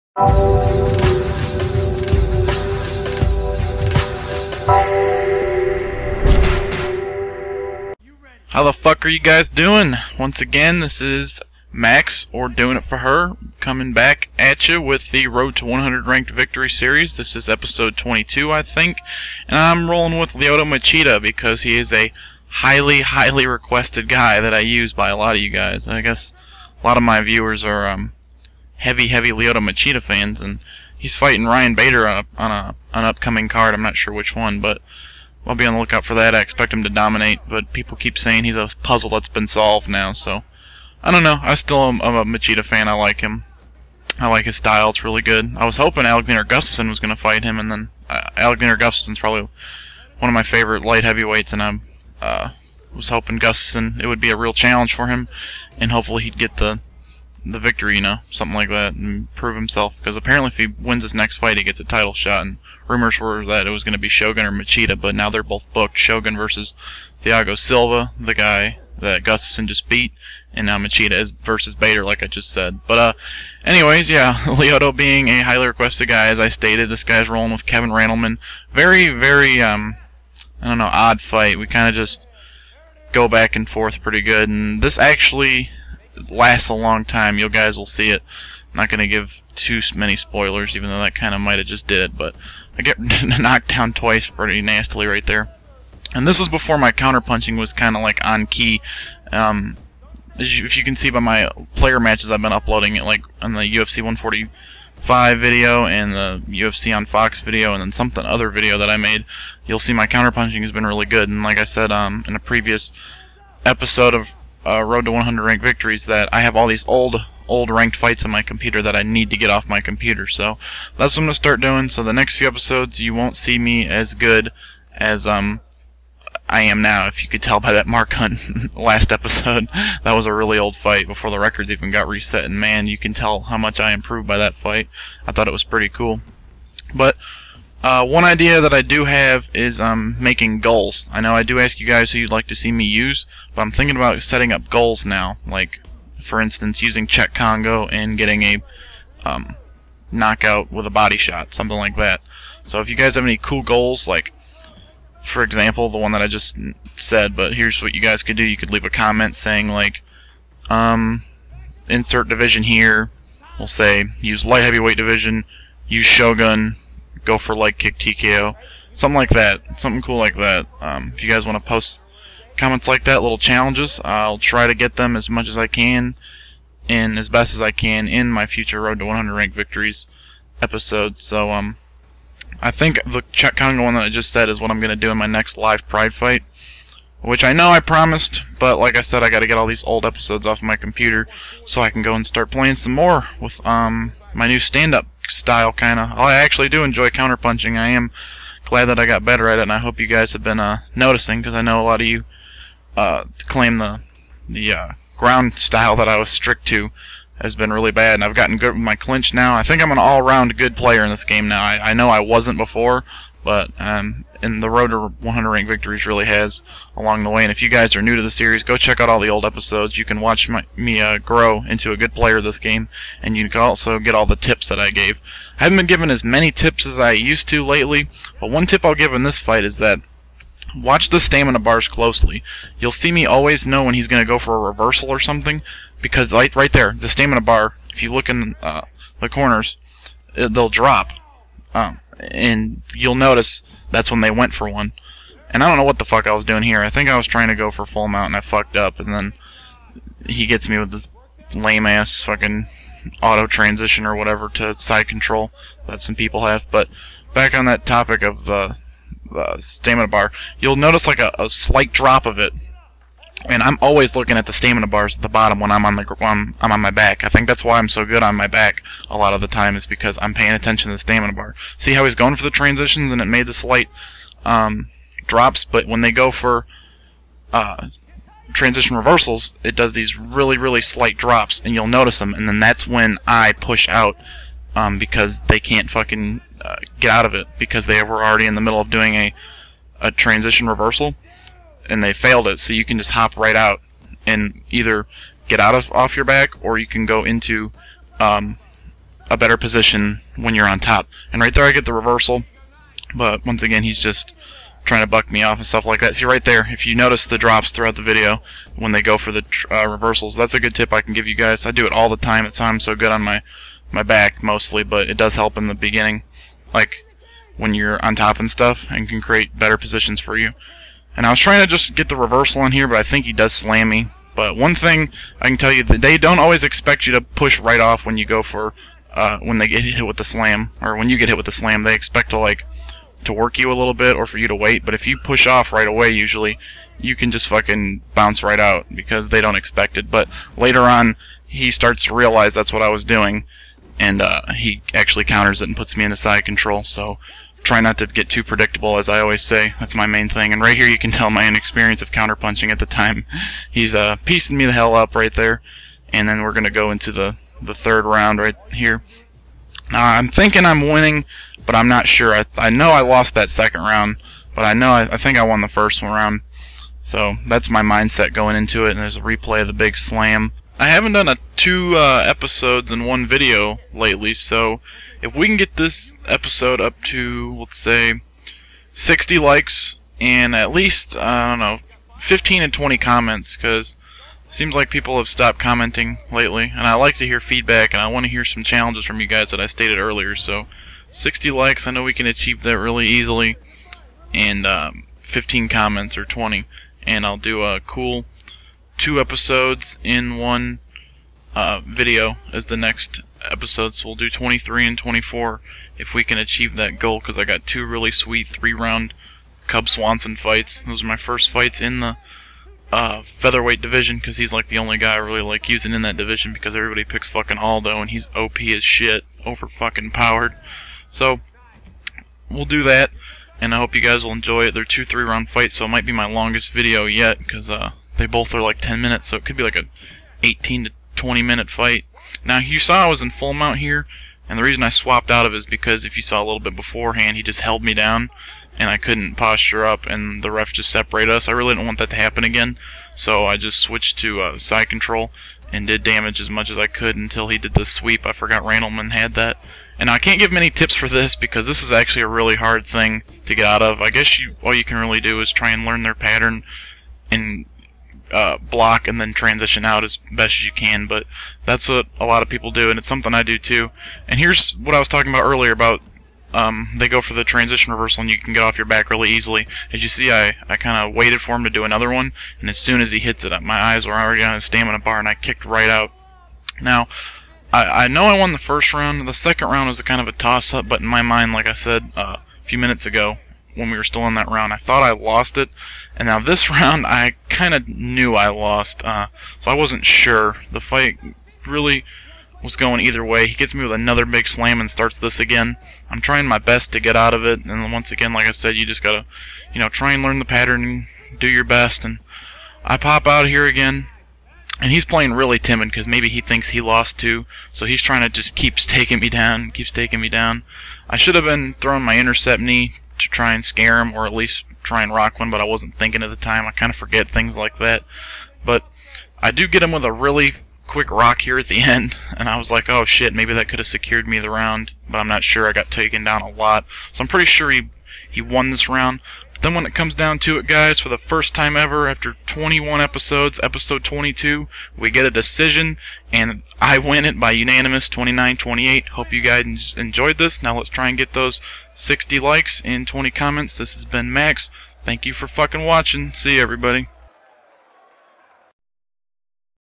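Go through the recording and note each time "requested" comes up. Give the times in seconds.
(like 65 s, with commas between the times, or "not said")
23 s, 75 s.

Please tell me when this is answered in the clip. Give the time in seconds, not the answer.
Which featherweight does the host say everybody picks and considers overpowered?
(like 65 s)
417 s.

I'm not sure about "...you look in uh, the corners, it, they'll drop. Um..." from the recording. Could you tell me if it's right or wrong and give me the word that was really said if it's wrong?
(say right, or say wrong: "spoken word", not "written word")
right.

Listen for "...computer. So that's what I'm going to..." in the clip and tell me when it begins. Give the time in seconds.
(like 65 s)
119 s.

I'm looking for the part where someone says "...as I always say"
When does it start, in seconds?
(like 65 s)
348 s.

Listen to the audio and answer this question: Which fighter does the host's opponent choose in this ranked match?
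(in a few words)
Kevin Randleman.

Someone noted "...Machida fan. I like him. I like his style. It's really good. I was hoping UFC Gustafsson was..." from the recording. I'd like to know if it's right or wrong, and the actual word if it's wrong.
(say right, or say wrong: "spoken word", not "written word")
wrong: "Alexander", not "UFC".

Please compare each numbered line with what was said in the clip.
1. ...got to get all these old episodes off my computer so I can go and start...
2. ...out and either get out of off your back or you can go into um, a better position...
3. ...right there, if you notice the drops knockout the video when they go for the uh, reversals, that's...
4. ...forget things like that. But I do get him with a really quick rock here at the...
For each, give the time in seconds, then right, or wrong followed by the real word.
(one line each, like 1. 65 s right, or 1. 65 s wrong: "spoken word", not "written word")
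1. 189 s right
2. 293 s right
3. 306 s wrong: "throughout", not "knockout"
4. 516 s right.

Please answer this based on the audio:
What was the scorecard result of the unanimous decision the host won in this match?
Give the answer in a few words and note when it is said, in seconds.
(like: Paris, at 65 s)
29-28, at 538 s.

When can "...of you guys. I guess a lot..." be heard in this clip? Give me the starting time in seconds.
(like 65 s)
25 s.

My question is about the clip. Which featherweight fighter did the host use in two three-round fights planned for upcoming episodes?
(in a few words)
Cub Swanson.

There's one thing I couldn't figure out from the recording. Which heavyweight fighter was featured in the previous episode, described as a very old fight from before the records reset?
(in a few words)
Mark Hunt.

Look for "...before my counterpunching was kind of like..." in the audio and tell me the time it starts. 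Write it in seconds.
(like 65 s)
96 s.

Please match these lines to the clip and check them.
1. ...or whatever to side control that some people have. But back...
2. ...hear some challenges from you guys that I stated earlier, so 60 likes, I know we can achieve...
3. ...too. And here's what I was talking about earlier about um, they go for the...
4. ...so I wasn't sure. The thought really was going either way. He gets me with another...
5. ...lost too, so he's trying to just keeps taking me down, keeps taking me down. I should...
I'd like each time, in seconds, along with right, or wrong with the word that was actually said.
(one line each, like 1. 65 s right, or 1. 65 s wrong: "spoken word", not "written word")
1. 254 s right
2. 388 s right
3. 463 s right
4. 489 s wrong: "fight", not "thought"
5. 506 s right.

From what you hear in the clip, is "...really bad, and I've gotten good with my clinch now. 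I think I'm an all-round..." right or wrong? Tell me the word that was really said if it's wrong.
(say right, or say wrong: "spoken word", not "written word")
right.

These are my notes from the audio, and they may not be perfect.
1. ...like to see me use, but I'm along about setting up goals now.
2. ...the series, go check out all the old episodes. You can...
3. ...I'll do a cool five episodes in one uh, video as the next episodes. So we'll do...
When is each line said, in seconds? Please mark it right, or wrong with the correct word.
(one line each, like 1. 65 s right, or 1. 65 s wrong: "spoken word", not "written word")
1. 142 s wrong: "thinking", not "along"
2. 218 s right
3. 397 s wrong: "two", not "five".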